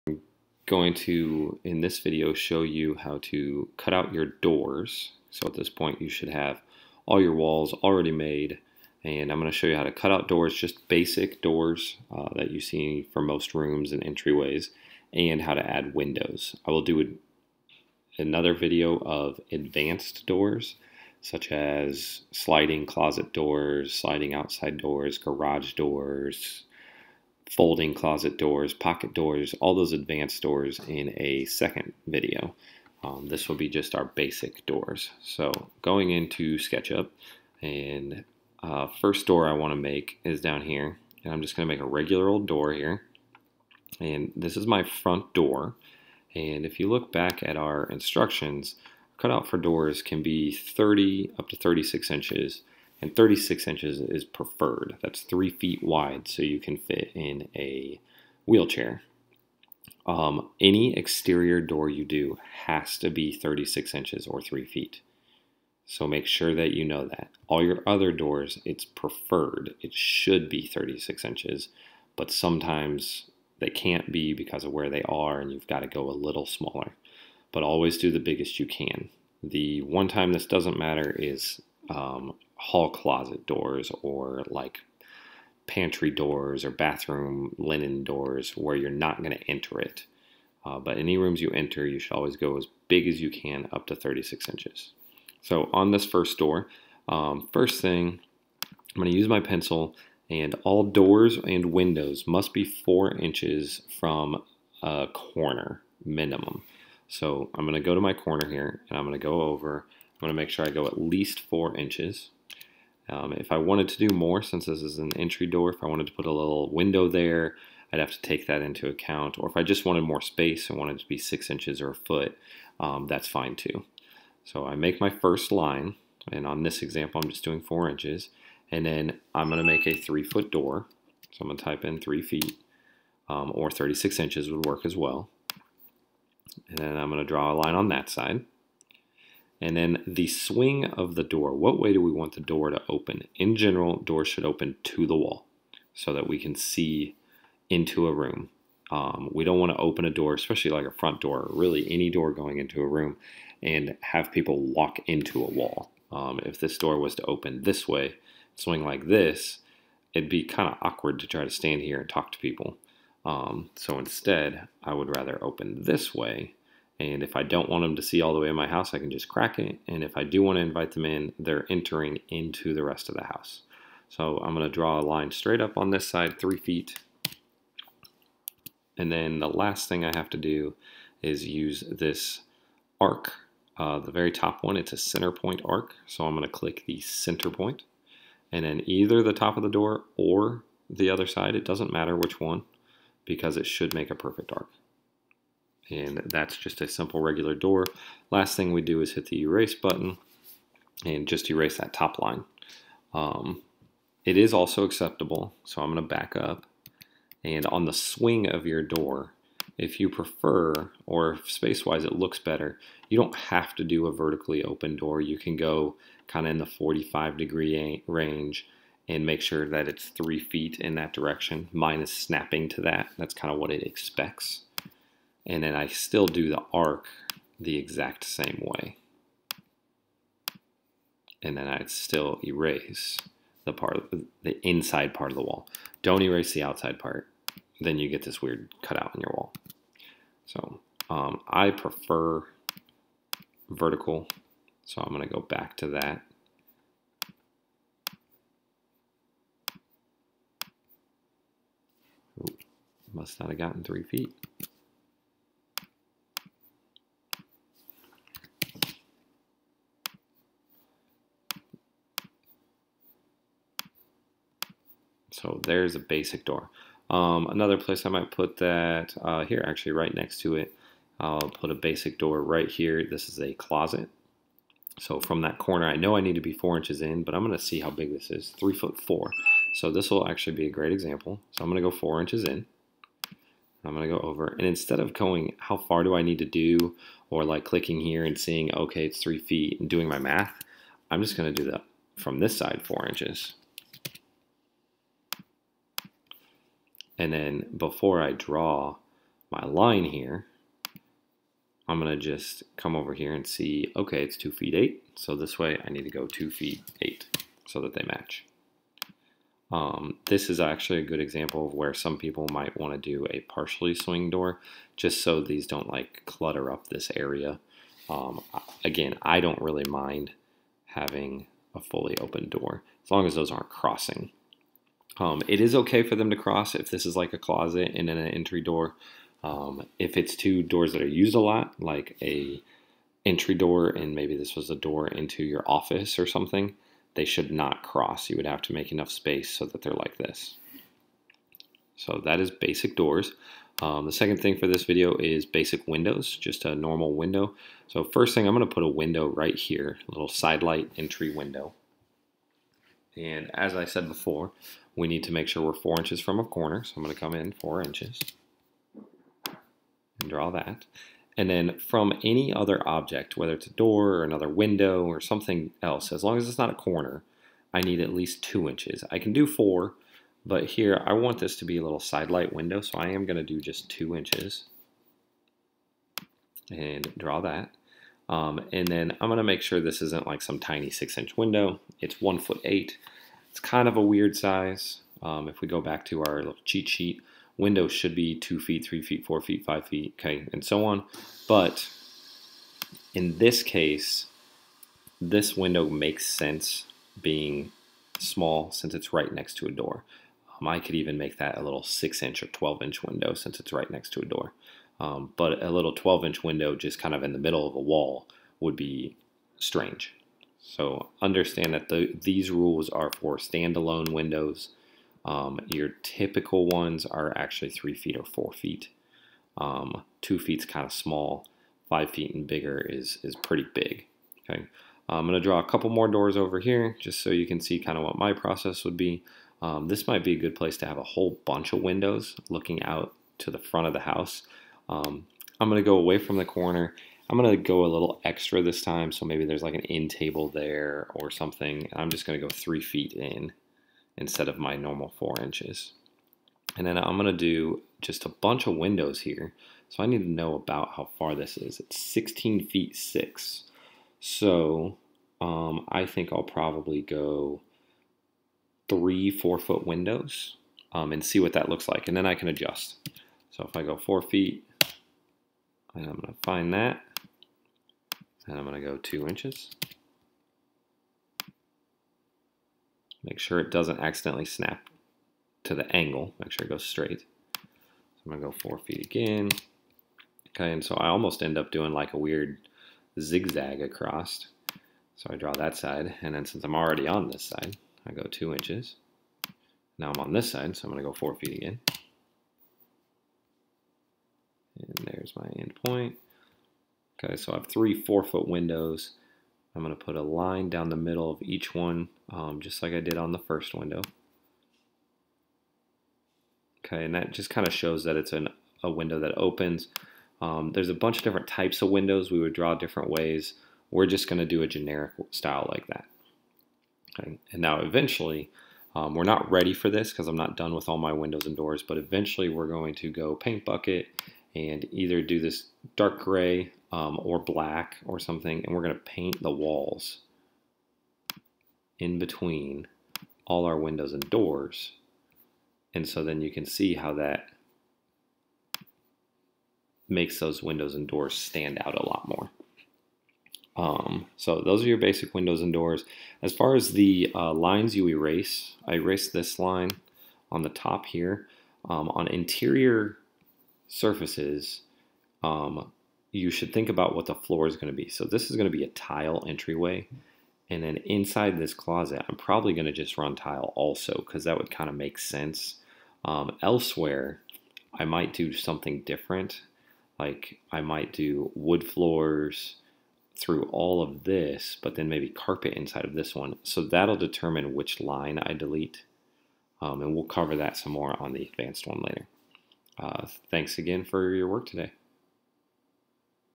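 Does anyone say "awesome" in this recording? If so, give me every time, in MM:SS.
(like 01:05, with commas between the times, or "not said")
not said.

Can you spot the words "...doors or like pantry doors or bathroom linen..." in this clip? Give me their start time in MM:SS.
01:23.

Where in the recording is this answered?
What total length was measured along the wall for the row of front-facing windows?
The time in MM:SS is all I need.
07:32.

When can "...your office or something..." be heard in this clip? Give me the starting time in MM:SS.
05:35.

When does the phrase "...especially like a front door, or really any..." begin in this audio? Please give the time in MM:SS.
02:30.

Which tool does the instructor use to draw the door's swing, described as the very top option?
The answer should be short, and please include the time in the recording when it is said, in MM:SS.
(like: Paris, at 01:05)
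center point arc, at 03:04.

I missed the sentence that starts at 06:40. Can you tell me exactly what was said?
Um, I could even make that a little 6 inch or 12 inch window since it's right next to a door.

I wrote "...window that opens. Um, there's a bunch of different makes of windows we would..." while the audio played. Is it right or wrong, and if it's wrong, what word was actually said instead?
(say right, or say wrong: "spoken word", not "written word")
wrong: "types", not "makes".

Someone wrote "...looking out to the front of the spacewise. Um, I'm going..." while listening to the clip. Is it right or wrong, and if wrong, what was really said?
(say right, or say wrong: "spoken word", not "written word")
wrong: "house", not "spacewise".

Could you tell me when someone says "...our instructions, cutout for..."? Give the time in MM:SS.
00:47.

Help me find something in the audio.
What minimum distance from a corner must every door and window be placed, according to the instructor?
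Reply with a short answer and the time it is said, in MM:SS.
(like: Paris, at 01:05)
4 inches, at 01:42.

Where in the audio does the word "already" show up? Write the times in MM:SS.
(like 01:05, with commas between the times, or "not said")
00:07, 08:06.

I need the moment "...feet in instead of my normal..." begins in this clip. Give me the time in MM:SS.
07:22.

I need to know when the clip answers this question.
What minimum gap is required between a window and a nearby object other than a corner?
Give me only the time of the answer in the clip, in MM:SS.
06:08.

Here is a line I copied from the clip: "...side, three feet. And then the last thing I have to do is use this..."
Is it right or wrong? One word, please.
right.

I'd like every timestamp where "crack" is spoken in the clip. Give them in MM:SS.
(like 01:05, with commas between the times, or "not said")
02:49.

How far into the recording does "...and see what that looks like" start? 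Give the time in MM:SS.
07:41.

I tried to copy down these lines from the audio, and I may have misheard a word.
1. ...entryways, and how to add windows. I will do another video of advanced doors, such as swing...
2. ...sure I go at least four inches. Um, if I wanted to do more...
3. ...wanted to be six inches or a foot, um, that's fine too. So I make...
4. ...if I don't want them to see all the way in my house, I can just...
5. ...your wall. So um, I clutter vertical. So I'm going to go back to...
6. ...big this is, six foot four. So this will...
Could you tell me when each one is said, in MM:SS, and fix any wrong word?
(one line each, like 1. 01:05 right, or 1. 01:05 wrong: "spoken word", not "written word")
1. 00:14 wrong: "sliding", not "swing"
2. 01:50 right
3. 02:00 right
4. 02:47 right
5. 03:59 wrong: "prefer", not "clutter"
6. 04:37 wrong: "three", not "six".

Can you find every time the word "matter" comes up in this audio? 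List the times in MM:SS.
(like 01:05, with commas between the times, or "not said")
01:20, 03:11.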